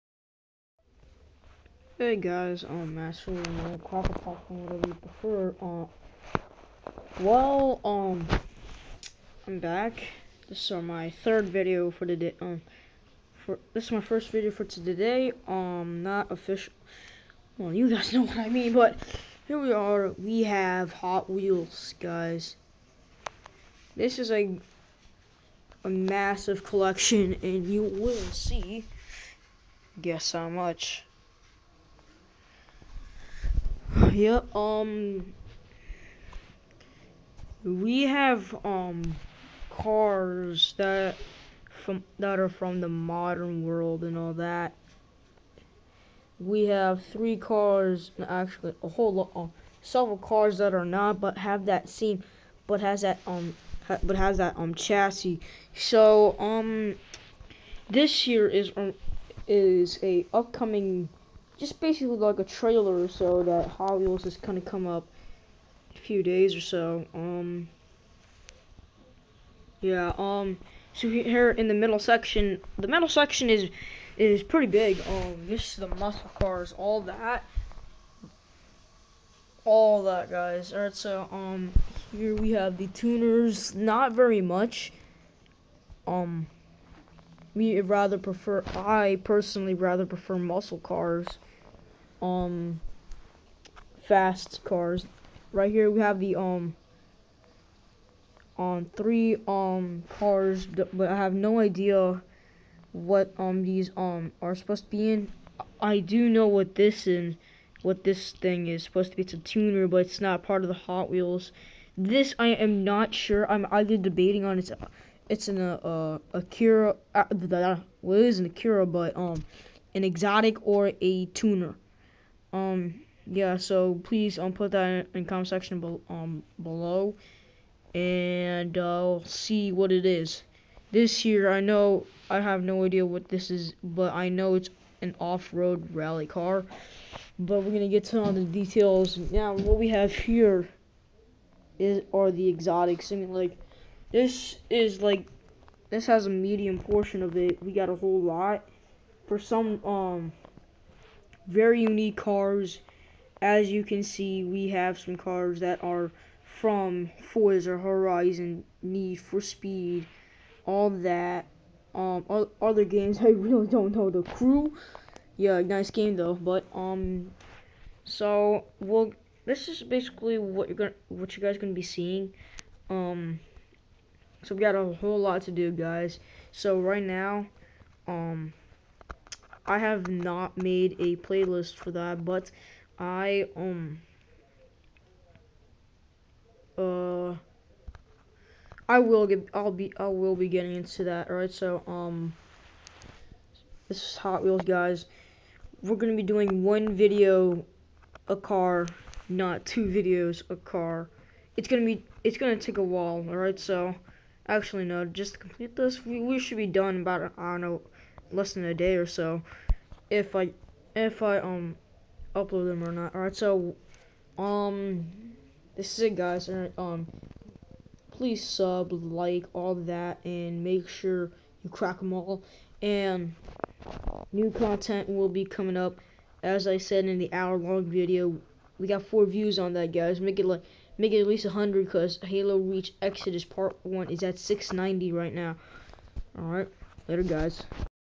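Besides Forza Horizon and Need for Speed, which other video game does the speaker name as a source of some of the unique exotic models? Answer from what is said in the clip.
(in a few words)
The Crew.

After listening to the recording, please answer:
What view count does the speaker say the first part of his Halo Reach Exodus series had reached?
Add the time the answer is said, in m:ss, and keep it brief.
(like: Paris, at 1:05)
690, at 3:54.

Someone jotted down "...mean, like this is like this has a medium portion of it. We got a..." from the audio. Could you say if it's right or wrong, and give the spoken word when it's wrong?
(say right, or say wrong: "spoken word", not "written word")
right.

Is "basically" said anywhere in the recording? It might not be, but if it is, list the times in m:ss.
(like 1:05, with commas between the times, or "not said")
1:01, 2:49.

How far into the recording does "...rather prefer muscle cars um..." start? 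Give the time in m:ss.
1:29.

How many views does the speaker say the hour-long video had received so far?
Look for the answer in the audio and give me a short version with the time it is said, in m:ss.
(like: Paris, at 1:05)
4, at 3:49.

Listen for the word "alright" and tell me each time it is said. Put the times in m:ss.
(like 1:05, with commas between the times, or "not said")
3:11, 3:23, 3:33.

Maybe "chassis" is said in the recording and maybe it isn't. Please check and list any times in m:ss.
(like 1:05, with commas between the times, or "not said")
0:54.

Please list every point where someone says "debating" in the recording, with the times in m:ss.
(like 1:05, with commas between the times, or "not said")
1:53.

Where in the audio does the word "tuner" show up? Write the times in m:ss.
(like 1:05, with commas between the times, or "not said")
1:22, 1:49, 2:01.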